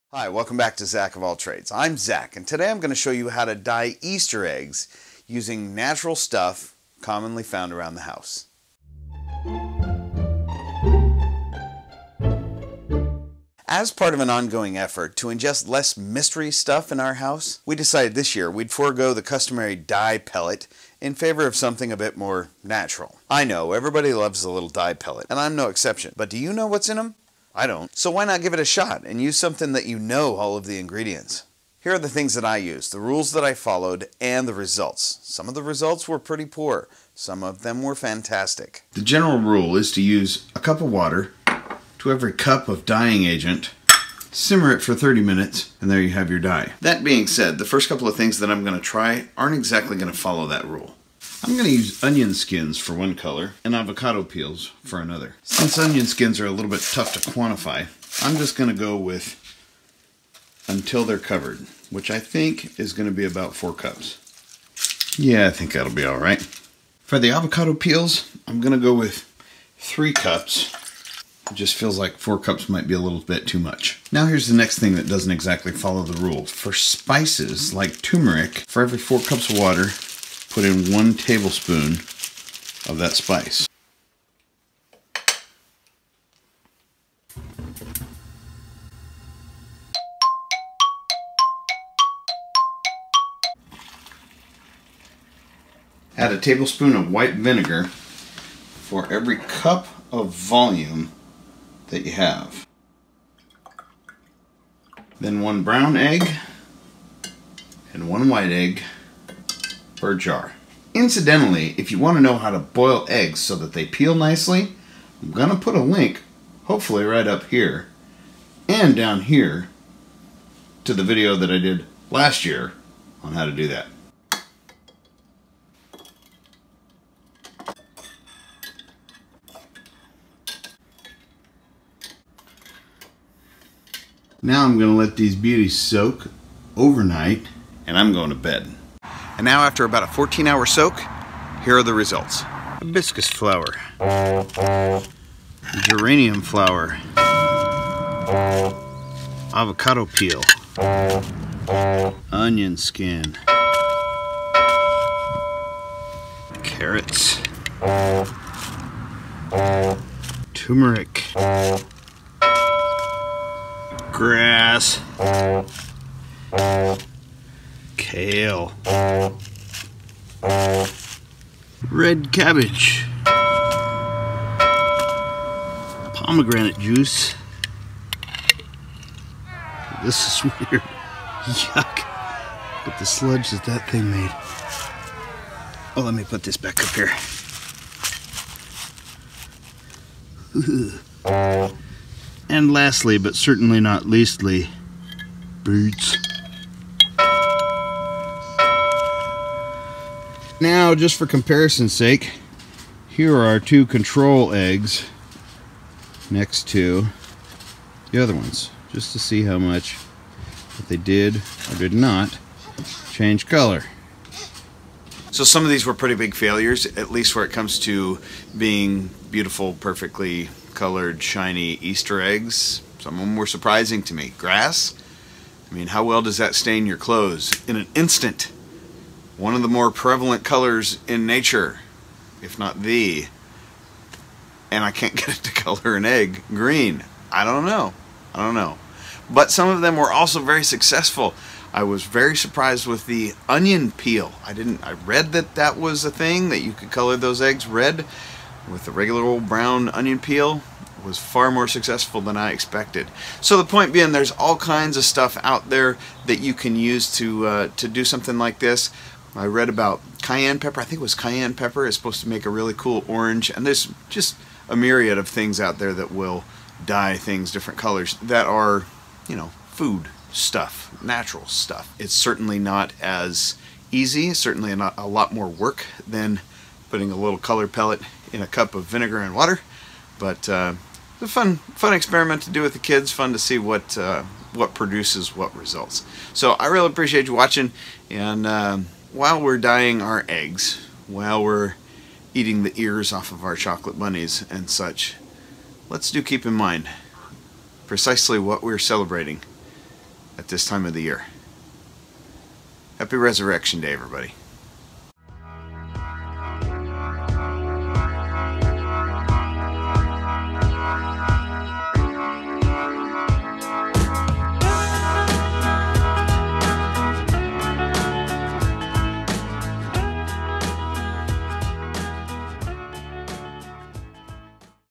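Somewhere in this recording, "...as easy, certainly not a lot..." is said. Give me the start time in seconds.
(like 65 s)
273 s.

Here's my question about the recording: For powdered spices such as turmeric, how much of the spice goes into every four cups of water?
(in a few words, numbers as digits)
1 tablespoon.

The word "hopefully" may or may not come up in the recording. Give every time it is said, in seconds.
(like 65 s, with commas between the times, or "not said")
116 s.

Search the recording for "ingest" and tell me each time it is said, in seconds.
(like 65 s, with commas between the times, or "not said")
15 s.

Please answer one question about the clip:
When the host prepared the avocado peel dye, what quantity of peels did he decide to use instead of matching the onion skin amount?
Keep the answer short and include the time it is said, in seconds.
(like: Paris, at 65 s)
3 cups, at 69 s.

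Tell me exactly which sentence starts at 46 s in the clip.
That being said, the first couple of things that I'm going to try aren't exactly going to follow that rule.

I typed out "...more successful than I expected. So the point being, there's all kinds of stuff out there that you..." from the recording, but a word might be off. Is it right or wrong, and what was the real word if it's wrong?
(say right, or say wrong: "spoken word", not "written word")
right.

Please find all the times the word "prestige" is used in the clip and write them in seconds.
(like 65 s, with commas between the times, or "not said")
not said.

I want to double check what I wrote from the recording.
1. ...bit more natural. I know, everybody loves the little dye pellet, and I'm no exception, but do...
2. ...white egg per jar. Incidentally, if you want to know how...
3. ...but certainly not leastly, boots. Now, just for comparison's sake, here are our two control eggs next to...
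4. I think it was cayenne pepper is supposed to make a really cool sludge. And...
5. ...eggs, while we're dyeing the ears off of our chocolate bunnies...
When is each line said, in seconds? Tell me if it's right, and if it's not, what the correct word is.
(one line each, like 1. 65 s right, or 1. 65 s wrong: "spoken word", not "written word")
1. 21 s right
2. 108 s right
3. 193 s right
4. 260 s wrong: "orange", not "sludge"
5. 290 s wrong: "eating", not "dyeing".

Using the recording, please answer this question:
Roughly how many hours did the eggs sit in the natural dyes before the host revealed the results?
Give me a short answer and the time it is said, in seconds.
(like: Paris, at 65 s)
14, at 140 s.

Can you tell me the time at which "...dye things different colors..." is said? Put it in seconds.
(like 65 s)
266 s.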